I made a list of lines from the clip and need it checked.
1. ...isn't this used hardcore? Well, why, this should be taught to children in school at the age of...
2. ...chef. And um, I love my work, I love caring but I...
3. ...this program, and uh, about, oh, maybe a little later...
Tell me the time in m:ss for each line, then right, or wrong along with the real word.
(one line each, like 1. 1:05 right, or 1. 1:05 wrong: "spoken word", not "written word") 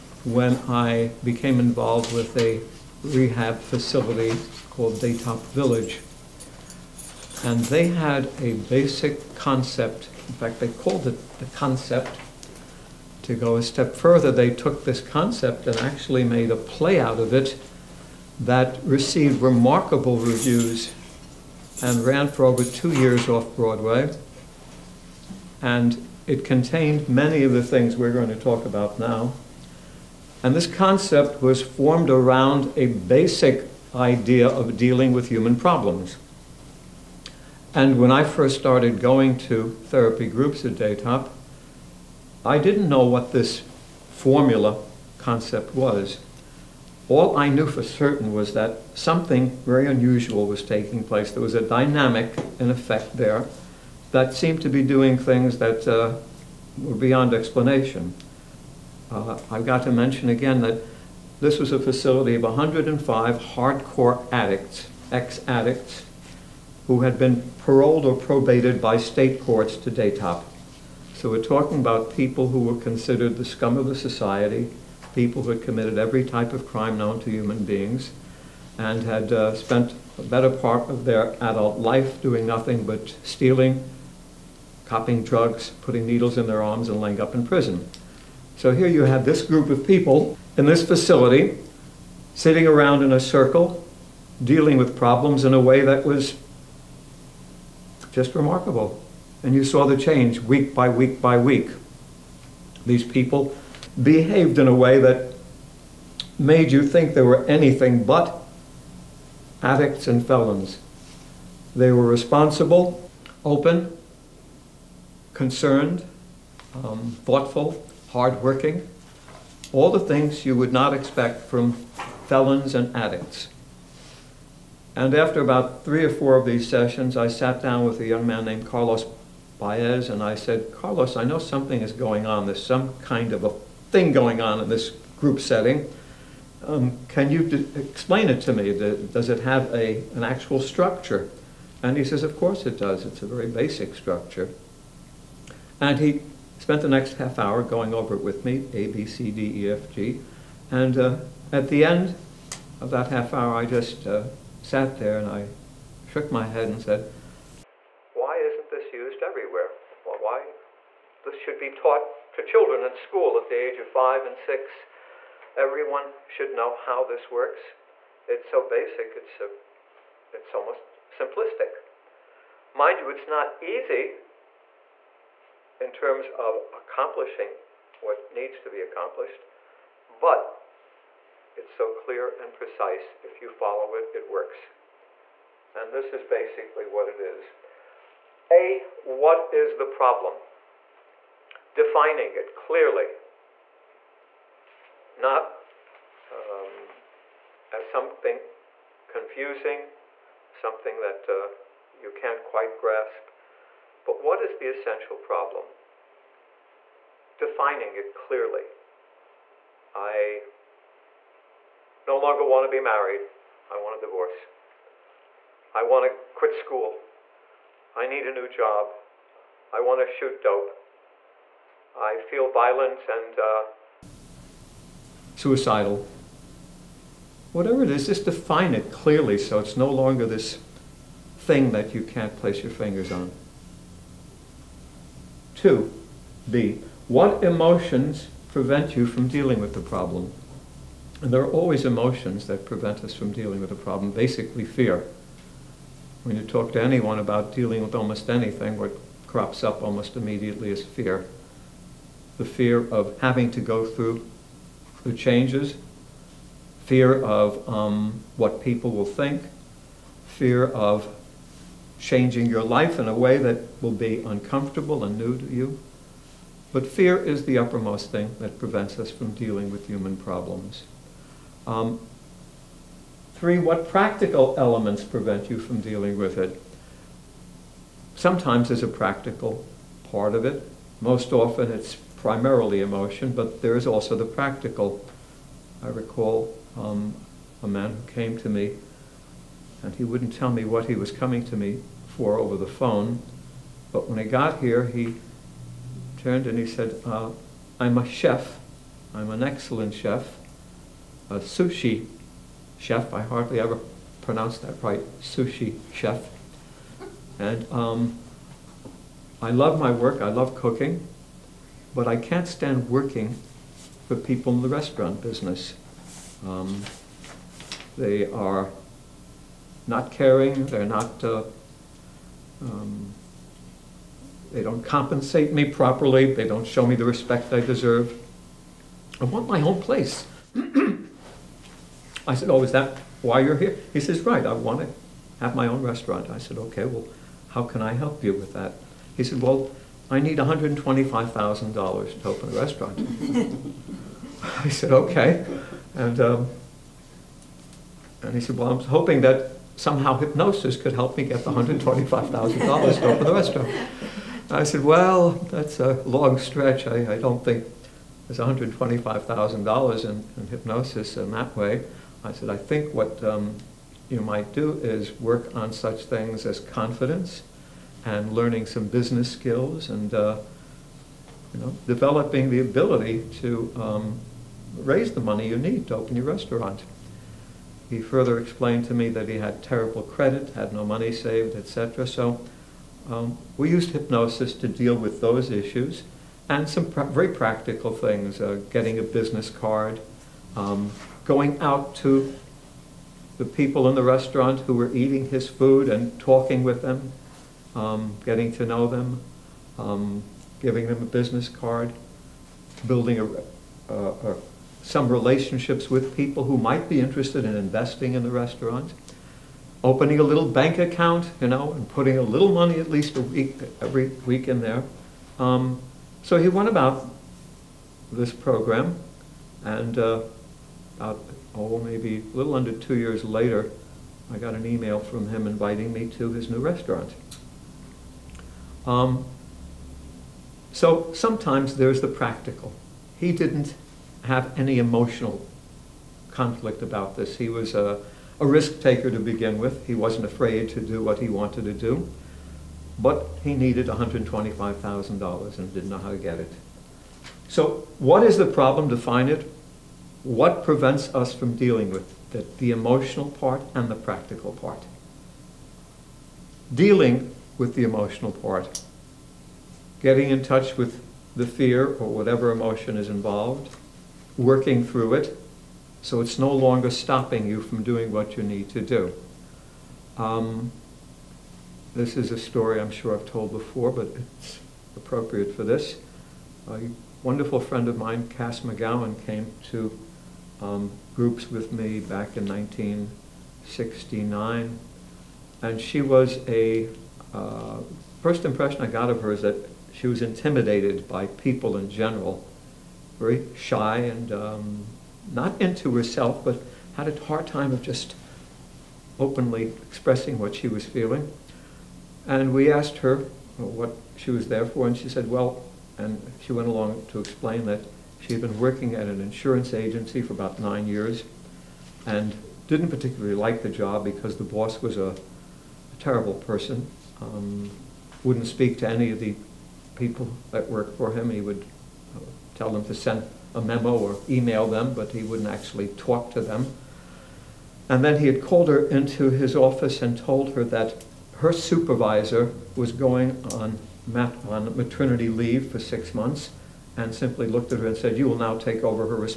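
1. 2:38 wrong: "everywhere", not "hardcore"
2. 5:05 wrong: "cooking", not "caring"
3. 6:58 wrong: "under", not "later".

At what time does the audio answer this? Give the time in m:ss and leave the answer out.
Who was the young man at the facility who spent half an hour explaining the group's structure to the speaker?
2:08.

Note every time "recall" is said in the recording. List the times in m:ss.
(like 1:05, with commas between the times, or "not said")
4:45.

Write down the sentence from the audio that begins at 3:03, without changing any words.
If you follow it, it works.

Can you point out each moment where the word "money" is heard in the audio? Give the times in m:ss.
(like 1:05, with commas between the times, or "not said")
6:15, 6:20, 6:52.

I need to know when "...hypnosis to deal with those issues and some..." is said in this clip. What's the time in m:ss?
6:23.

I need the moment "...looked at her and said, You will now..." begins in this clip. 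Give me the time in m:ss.
8:57.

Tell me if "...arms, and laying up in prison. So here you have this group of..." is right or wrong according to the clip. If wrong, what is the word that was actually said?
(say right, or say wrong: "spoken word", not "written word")
right.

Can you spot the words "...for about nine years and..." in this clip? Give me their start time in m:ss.
8:30.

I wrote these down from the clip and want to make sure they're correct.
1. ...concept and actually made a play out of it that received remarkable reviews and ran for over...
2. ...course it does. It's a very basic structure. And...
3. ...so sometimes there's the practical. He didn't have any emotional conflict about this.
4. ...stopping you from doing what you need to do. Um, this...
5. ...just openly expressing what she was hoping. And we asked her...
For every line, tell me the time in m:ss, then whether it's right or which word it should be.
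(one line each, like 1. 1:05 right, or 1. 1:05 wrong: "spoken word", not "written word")
1. 0:14 right
2. 2:22 right
3. 7:10 right
4. 7:46 right
5. 8:17 wrong: "feeling", not "hoping".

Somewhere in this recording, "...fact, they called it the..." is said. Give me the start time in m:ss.
0:10.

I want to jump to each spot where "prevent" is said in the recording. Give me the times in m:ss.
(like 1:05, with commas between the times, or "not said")
3:58, 4:02, 4:28, 4:35, 7:30.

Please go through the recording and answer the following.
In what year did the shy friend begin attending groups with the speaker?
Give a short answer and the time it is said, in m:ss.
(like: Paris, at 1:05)
1969, at 8:02.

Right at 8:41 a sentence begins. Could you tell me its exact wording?
He would uh, tell them to send a memo or email them, but he wouldn't actually talk to them.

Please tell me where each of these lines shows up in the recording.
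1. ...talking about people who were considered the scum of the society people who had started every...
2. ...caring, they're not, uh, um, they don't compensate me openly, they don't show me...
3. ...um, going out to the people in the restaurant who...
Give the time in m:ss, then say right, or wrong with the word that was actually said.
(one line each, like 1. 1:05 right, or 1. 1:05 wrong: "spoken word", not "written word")
1. 1:11 wrong: "committed", not "started"
2. 5:20 wrong: "properly", not "openly"
3. 6:30 right.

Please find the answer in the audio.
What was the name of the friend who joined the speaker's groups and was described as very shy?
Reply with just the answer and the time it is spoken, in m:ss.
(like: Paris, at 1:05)
Cass McGowan, at 7:58.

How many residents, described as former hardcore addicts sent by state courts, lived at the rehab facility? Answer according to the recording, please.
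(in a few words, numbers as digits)
105.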